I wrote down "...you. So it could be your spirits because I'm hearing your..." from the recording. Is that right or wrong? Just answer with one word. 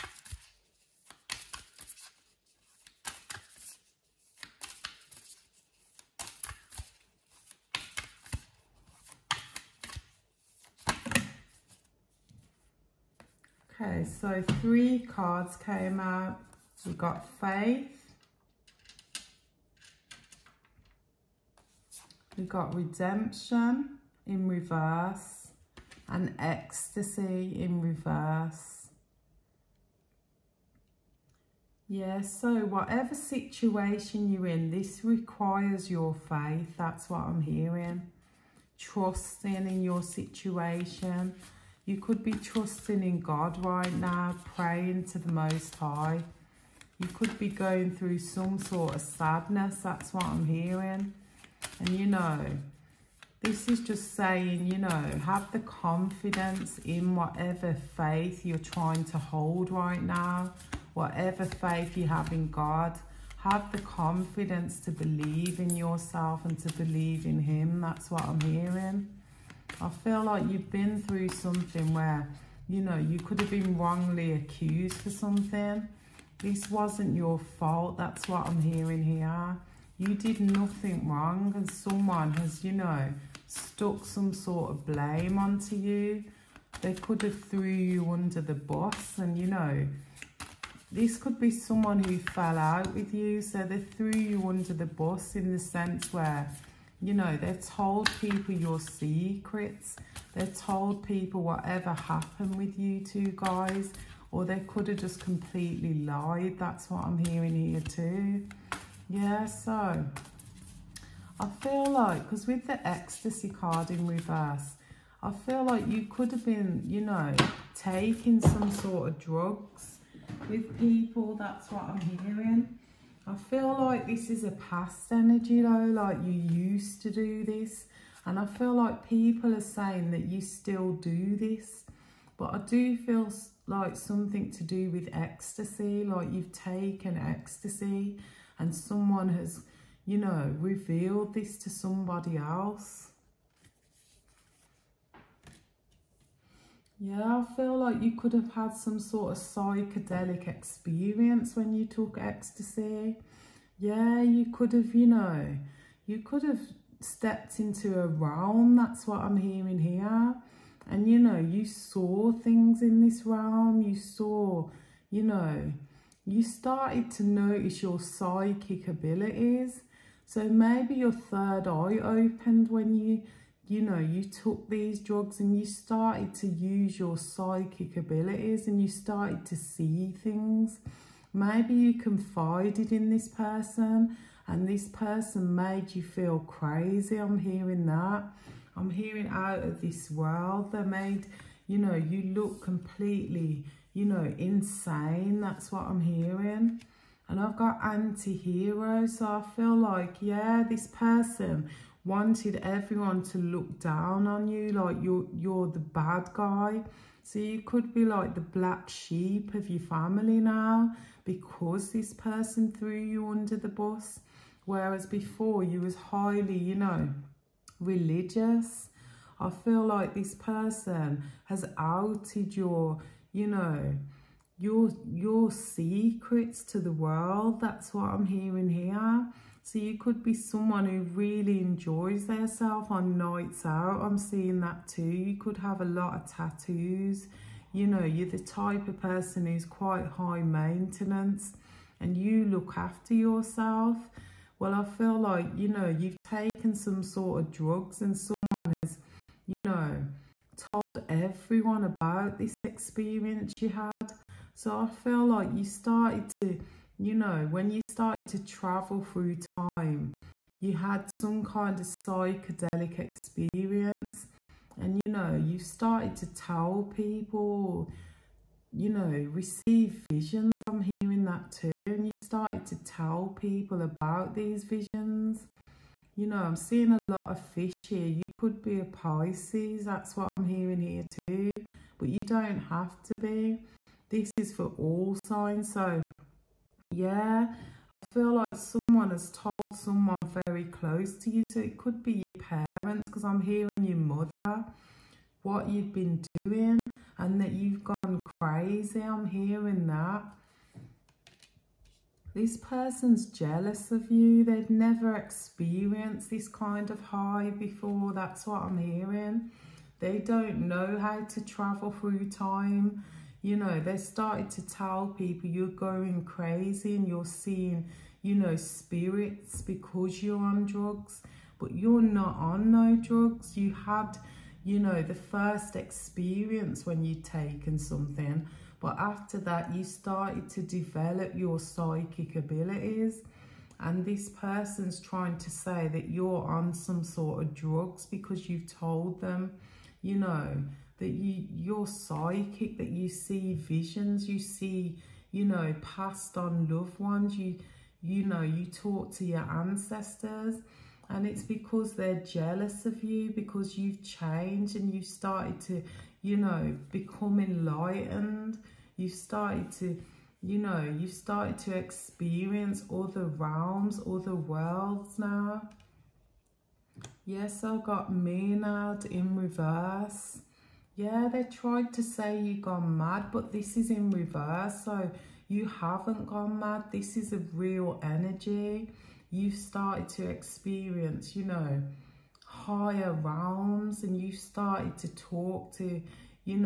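wrong.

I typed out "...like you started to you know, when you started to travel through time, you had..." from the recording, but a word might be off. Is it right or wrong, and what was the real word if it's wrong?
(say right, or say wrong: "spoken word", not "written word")
right.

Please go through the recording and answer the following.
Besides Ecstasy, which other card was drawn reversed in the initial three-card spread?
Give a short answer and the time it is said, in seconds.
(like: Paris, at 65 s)
Redemption, at 22 s.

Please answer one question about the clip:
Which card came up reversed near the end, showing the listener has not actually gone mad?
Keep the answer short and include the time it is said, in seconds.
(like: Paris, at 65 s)
Me Now, at 368 s.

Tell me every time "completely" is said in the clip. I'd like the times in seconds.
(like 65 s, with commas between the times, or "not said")
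105 s, 192 s.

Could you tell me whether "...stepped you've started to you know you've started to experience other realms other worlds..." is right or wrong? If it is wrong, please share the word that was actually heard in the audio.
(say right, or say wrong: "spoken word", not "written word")
wrong: "enlightened", not "stepped".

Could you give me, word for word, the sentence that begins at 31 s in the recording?
Yeah, so whatever situation you're in, this requires your faith.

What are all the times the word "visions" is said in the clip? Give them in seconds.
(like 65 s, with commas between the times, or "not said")
269 s, 274 s, 343 s.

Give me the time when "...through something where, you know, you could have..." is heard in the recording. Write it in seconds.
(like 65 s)
71 s.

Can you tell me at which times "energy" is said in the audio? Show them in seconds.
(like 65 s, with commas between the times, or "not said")
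125 s, 378 s.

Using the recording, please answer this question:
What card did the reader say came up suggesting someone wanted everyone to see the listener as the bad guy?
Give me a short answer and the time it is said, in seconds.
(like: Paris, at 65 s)
Anti-hero, at 197 s.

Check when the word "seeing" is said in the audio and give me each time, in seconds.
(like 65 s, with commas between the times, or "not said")
234 s, 276 s, 317 s.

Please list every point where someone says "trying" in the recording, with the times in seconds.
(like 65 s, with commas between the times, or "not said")
58 s, 334 s.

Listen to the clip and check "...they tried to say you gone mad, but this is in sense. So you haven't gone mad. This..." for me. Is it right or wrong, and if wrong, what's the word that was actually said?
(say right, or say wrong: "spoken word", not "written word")
wrong: "reverse", not "sense".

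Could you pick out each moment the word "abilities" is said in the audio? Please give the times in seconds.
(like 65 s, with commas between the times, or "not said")
168 s, 177 s, 332 s.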